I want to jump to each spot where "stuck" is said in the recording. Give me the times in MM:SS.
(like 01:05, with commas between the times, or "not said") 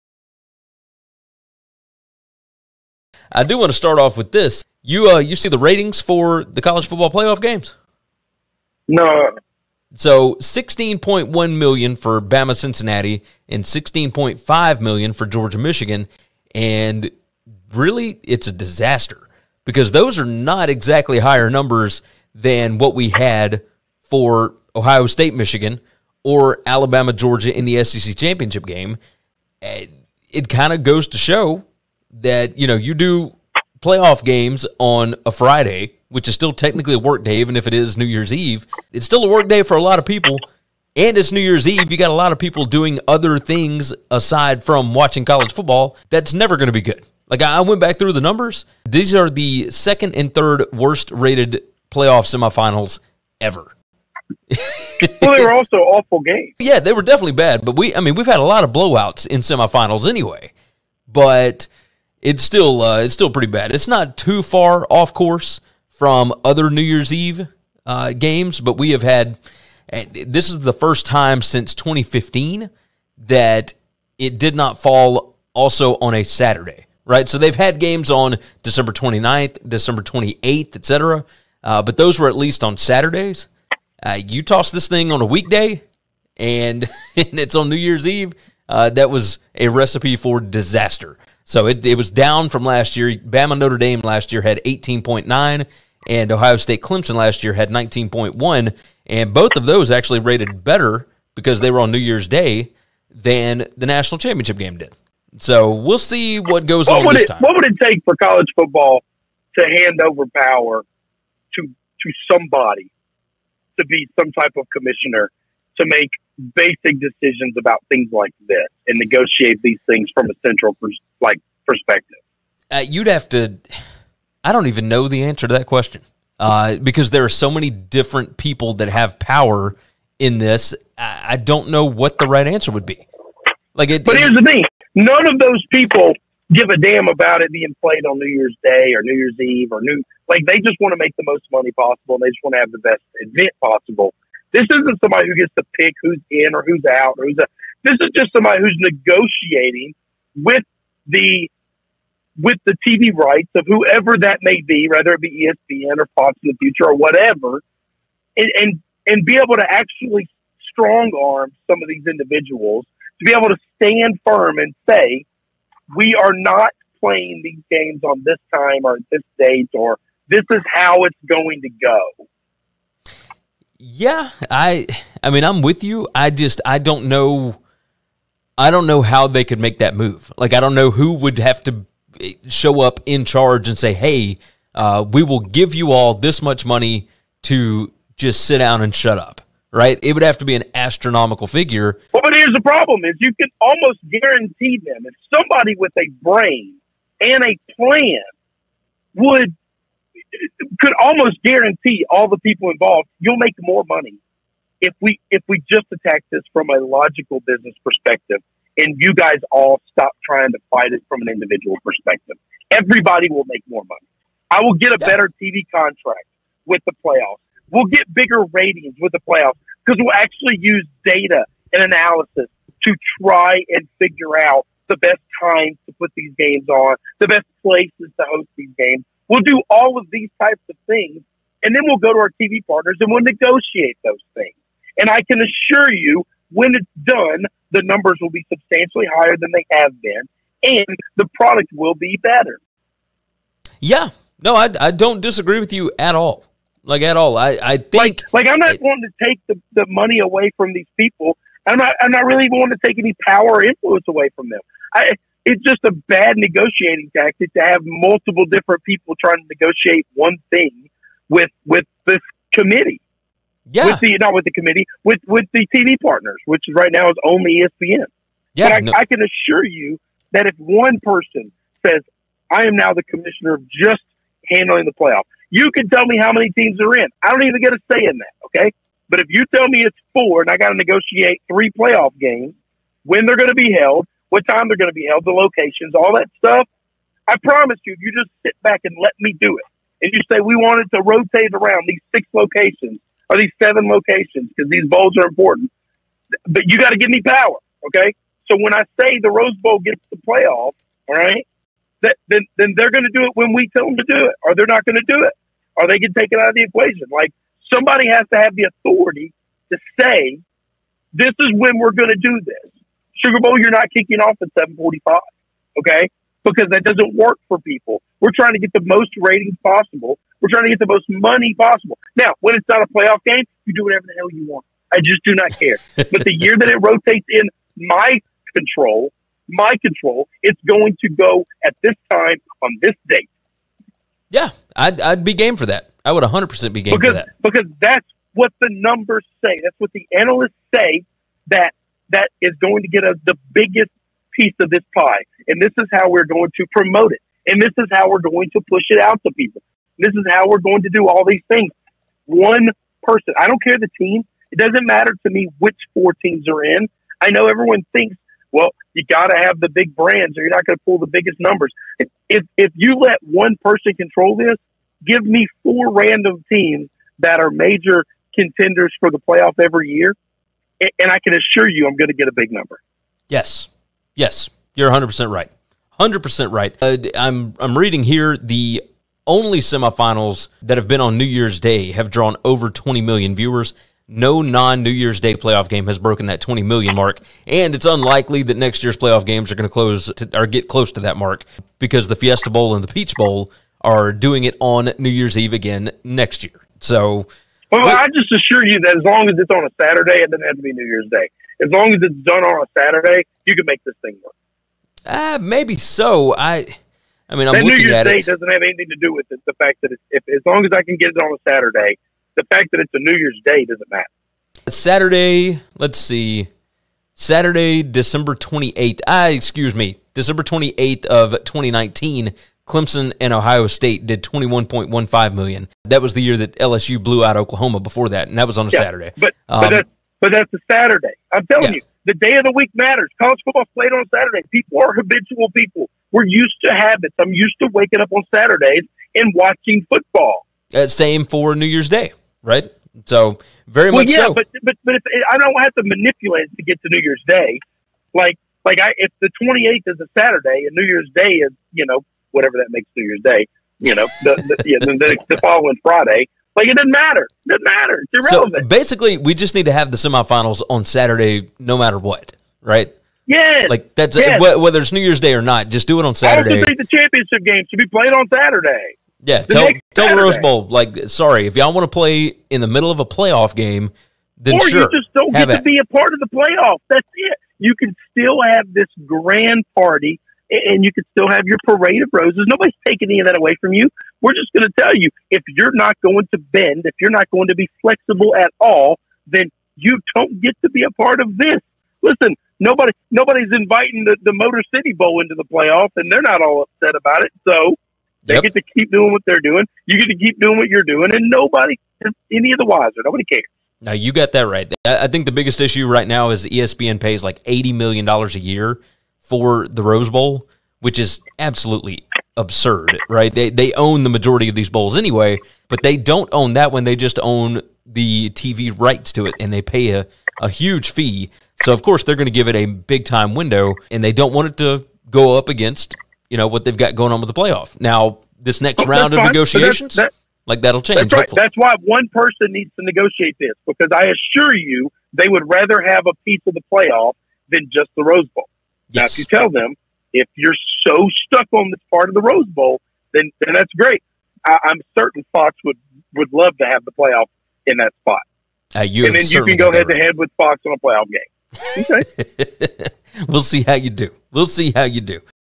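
09:01.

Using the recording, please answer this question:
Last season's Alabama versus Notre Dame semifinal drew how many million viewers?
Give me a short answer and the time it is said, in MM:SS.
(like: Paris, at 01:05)
18.9 million, at 01:34.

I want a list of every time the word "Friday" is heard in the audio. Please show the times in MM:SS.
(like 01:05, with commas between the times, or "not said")
00:35, 07:35.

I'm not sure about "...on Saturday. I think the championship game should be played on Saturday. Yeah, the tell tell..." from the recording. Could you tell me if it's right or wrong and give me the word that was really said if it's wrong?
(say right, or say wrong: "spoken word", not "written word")
right.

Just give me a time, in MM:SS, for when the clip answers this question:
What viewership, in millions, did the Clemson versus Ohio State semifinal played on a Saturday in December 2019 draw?
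07:04.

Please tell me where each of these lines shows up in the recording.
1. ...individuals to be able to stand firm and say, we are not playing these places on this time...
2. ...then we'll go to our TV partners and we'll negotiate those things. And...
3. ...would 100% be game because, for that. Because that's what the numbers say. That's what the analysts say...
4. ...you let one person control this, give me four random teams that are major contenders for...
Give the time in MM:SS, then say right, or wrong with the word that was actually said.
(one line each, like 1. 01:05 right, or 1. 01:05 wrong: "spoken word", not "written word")
1. 02:42 wrong: "games", not "places"
2. 03:51 right
3. 05:36 right
4. 06:02 right.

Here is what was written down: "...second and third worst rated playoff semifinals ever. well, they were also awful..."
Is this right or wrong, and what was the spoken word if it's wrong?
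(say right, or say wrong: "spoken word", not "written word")
right.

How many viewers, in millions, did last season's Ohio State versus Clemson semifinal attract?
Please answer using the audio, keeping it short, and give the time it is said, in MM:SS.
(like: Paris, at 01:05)
19.1 million, at 01:37.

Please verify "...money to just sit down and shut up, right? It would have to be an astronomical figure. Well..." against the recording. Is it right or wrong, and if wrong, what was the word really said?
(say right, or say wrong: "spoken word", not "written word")
right.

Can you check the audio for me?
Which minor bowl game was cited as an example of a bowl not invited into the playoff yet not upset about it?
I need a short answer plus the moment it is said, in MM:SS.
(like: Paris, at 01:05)
Motor City Bowl, at 08:14.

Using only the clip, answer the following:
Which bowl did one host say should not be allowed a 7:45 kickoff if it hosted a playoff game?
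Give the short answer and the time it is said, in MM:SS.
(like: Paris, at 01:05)
Sugar Bowl, at 05:13.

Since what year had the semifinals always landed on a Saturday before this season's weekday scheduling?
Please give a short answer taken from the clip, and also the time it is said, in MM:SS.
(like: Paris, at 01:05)
2015, at 01:11.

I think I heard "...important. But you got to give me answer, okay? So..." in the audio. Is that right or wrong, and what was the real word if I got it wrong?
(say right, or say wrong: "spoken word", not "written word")
wrong: "power", not "answer".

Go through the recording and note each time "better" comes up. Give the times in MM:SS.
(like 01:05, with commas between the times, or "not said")
01:40, 03:34, 04:02.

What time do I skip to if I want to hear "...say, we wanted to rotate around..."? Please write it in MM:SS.
04:50.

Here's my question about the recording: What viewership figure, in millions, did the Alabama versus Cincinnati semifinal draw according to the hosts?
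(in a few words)
16.1 million.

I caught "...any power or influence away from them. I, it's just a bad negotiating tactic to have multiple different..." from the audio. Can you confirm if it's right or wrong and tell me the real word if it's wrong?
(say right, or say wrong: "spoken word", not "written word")
right.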